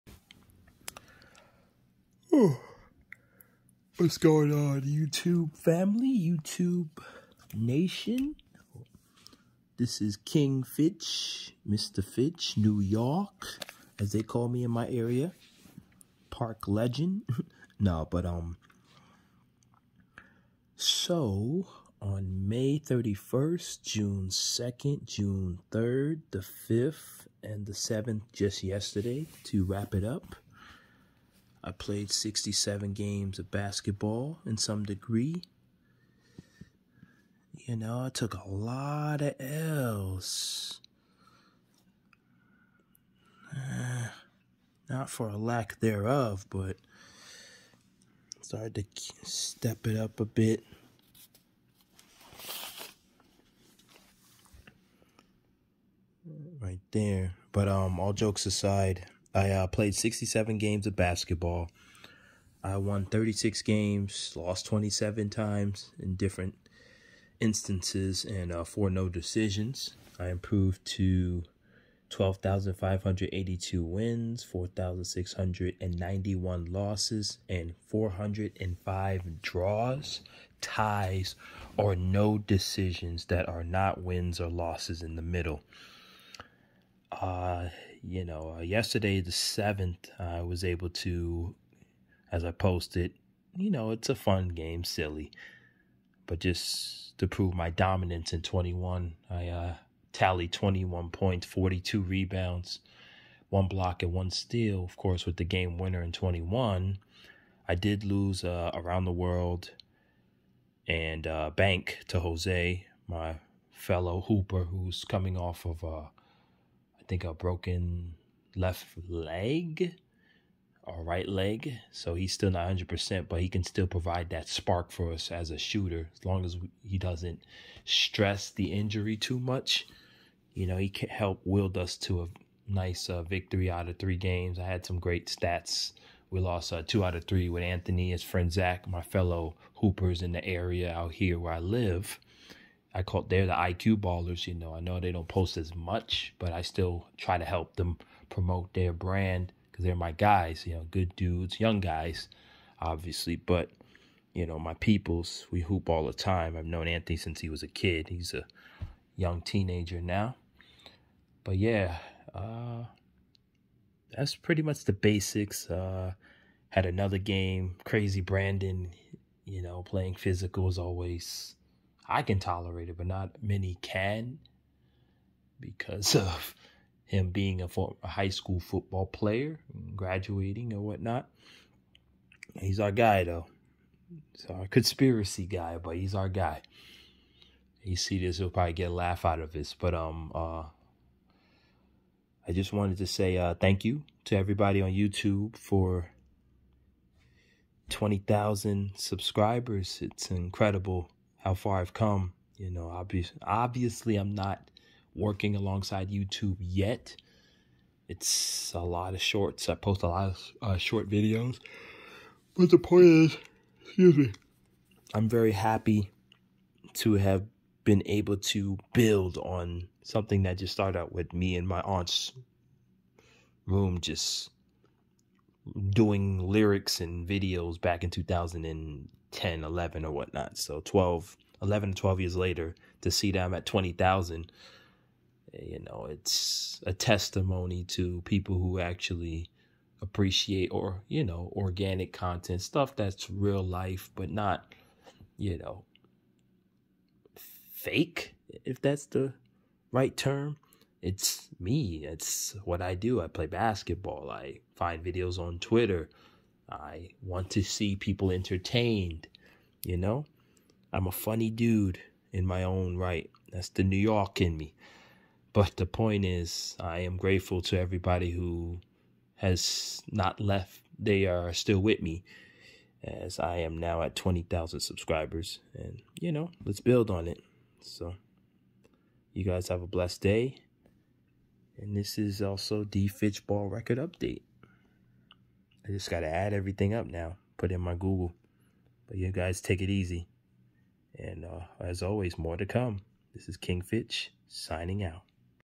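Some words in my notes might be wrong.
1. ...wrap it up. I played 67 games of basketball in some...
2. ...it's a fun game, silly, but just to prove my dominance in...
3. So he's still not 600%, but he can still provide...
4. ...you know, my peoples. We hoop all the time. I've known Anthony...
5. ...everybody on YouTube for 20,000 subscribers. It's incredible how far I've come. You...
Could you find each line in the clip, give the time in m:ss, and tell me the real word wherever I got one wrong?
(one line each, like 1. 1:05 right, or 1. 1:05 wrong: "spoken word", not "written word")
1. 0:29 right
2. 1:33 right
3. 2:01 wrong: "100", not "600"
4. 2:34 right
5. 3:14 right.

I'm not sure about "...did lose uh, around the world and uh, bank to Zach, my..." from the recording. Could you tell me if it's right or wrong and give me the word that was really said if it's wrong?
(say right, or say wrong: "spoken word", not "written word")
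wrong: "Jose", not "Zach".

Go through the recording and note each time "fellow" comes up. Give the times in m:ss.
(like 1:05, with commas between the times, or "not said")
1:53, 2:19.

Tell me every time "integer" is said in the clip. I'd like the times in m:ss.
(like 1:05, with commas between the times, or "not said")
not said.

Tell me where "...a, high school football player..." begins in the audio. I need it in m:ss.
2:57.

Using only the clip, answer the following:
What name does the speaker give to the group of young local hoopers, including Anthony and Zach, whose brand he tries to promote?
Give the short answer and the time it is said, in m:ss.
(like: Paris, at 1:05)
IQ ballers, at 2:23.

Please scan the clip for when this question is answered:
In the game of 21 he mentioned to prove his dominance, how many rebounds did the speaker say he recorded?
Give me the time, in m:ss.
1:41.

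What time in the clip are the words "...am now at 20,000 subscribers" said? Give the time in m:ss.
4:33.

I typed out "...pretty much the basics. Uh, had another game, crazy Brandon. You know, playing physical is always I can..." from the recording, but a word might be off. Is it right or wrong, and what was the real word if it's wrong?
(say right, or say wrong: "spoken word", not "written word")
right.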